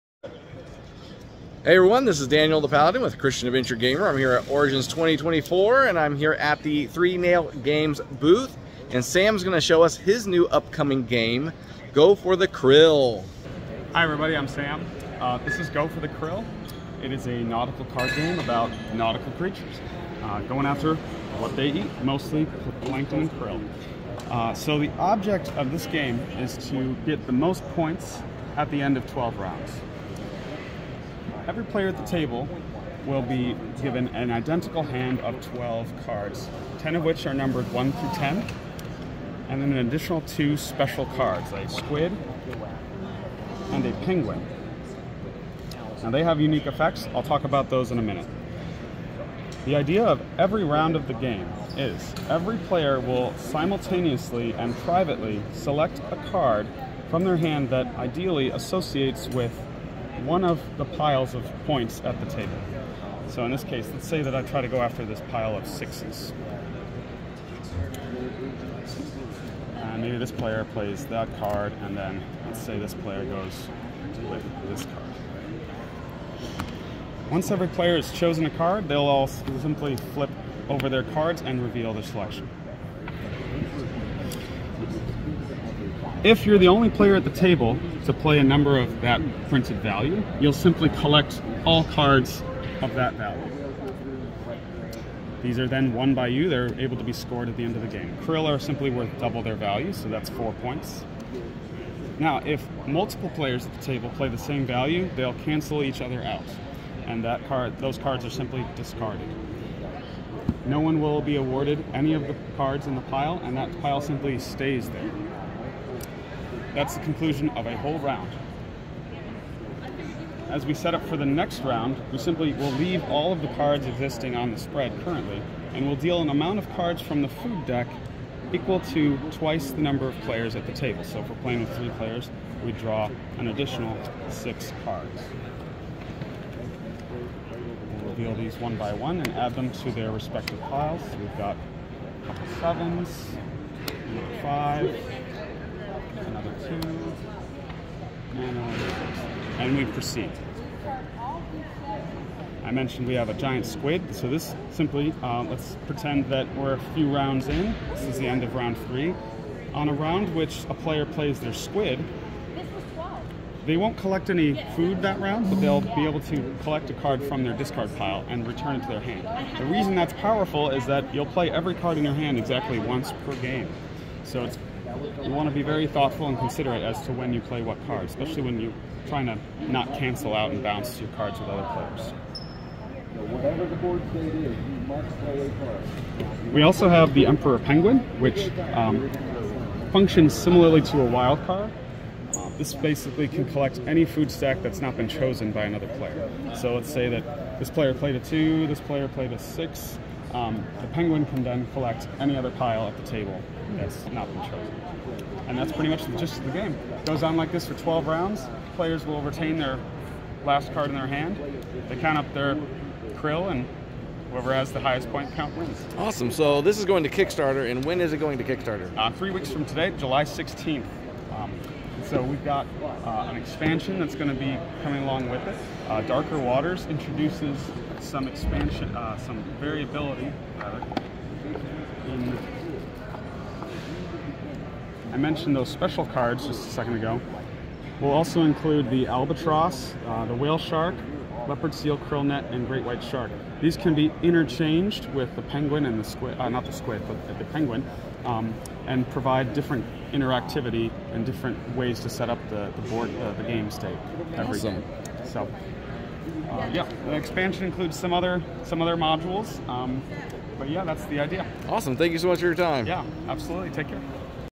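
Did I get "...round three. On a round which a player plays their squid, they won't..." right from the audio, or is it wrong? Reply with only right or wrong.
right.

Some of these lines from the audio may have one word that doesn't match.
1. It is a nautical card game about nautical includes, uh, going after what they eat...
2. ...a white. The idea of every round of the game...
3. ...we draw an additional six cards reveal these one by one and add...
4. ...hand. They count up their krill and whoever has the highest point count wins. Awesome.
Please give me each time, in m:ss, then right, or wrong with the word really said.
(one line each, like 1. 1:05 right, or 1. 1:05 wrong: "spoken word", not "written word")
1. 0:17 wrong: "creatures", not "includes"
2. 0:47 wrong: "minute", not "white"
3. 2:12 right
4. 3:31 right.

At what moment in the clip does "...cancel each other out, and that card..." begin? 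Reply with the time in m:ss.
1:45.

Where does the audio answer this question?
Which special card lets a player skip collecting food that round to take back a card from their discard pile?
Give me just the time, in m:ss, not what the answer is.
2:33.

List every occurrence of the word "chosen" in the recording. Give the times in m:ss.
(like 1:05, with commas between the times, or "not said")
1:18, 3:15, 3:24.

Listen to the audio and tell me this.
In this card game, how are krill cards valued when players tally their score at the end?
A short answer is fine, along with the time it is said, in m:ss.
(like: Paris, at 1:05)
Double their value, at 1:39.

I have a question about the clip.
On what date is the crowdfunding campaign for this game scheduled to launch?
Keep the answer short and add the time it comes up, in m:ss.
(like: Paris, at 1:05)
July 16th, at 3:39.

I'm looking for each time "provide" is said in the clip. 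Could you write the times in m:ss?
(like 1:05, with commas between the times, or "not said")
4:09.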